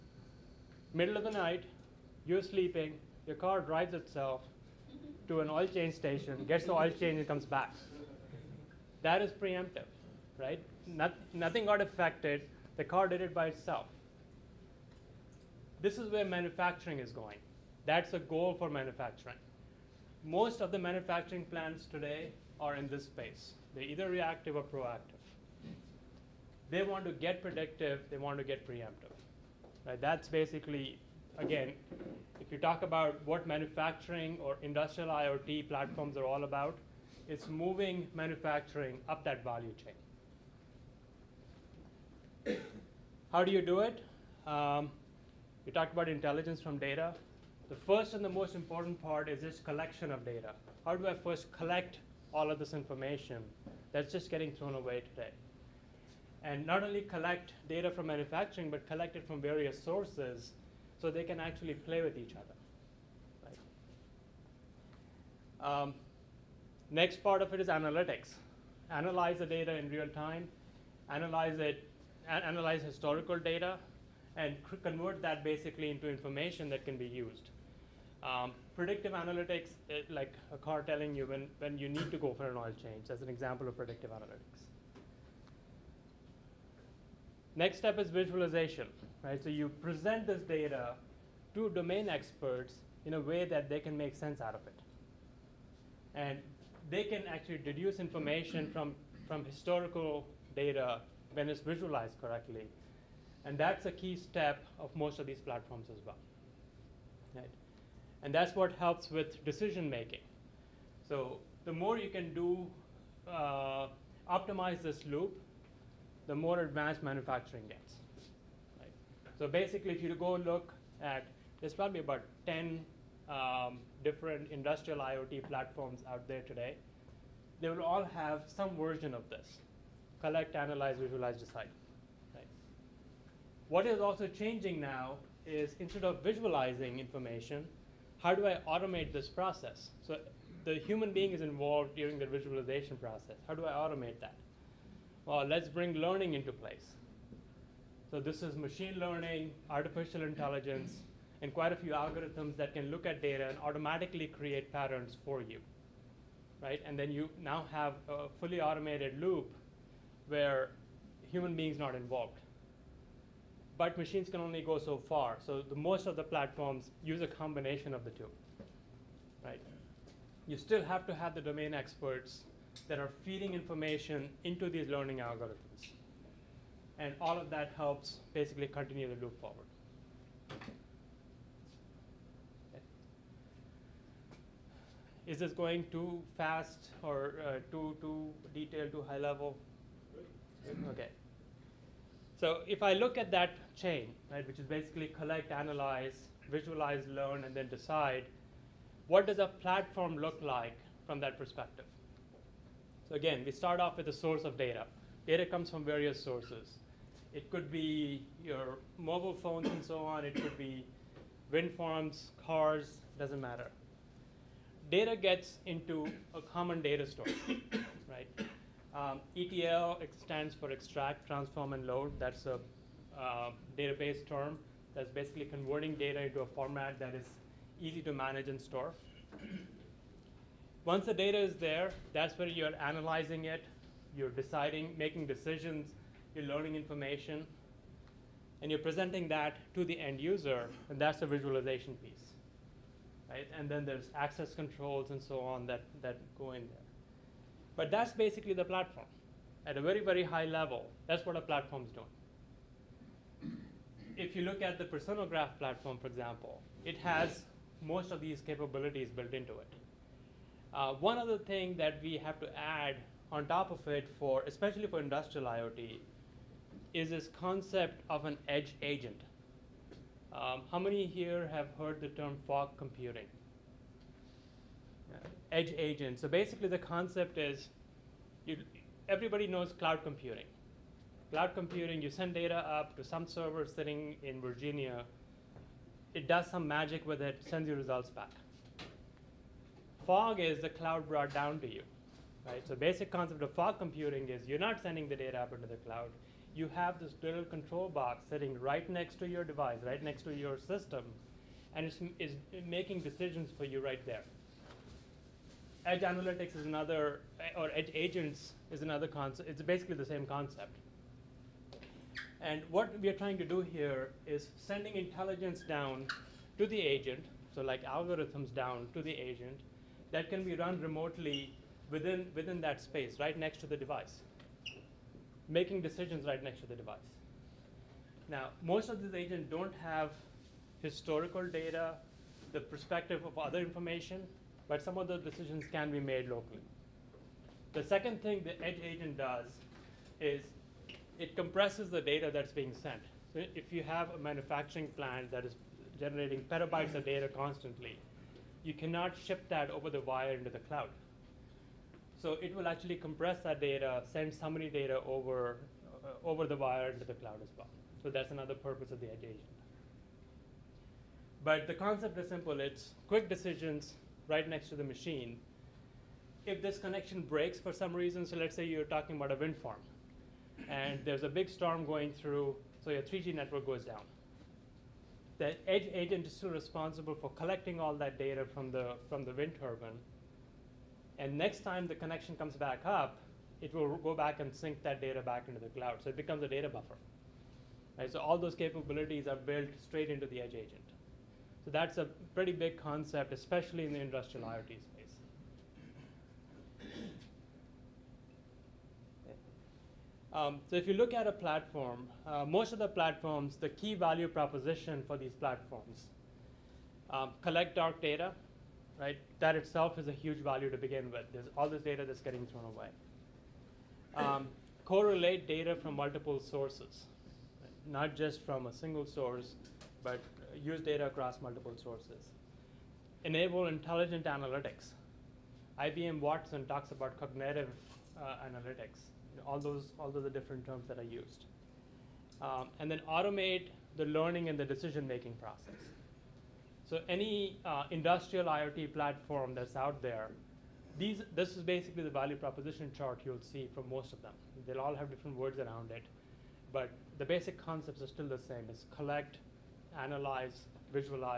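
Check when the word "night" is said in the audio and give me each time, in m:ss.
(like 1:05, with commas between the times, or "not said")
0:01.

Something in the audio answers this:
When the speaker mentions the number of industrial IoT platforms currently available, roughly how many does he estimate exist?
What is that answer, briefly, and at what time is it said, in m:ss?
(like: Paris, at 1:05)
10, at 2:02.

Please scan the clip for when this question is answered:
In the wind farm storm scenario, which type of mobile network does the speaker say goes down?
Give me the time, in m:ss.
6:13.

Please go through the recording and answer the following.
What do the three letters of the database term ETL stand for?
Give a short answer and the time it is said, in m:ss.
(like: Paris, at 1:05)
extract, transform, and load, at 3:40.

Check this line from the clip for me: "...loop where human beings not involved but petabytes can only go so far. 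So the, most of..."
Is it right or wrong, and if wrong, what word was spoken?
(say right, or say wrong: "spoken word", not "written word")
wrong: "machines", not "petabytes".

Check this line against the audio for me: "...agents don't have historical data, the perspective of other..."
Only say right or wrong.
right.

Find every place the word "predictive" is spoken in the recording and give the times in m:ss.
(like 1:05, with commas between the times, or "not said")
0:27, 1:18, 1:23.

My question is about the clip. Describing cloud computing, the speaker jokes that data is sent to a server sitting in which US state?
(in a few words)
Virginia.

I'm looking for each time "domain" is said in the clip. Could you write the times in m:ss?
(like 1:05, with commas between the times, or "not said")
1:31, 2:51.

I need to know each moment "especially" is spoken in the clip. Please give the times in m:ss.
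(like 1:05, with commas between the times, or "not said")
4:24, 6:33.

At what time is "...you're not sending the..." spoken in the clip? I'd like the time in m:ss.
4:54.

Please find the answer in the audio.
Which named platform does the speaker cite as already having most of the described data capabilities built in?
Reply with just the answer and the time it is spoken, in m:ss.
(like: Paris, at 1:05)
Personagraph, at 4:14.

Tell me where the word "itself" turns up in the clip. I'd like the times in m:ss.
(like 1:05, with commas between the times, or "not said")
0:03, 0:13, 6:49.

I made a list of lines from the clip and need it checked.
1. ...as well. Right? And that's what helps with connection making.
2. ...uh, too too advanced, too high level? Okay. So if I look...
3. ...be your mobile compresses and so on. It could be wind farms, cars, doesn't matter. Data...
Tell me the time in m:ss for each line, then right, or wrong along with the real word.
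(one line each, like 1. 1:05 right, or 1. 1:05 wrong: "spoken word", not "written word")
1. 1:45 wrong: "decision", not "connection"
2. 3:07 wrong: "detailed", not "advanced"
3. 3:27 wrong: "phones", not "compresses".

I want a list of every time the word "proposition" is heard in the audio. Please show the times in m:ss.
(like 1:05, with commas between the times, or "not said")
6:44, 7:22.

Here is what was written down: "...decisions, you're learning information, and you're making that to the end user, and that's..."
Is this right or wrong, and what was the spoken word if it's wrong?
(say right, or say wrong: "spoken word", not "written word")
wrong: "presenting", not "making".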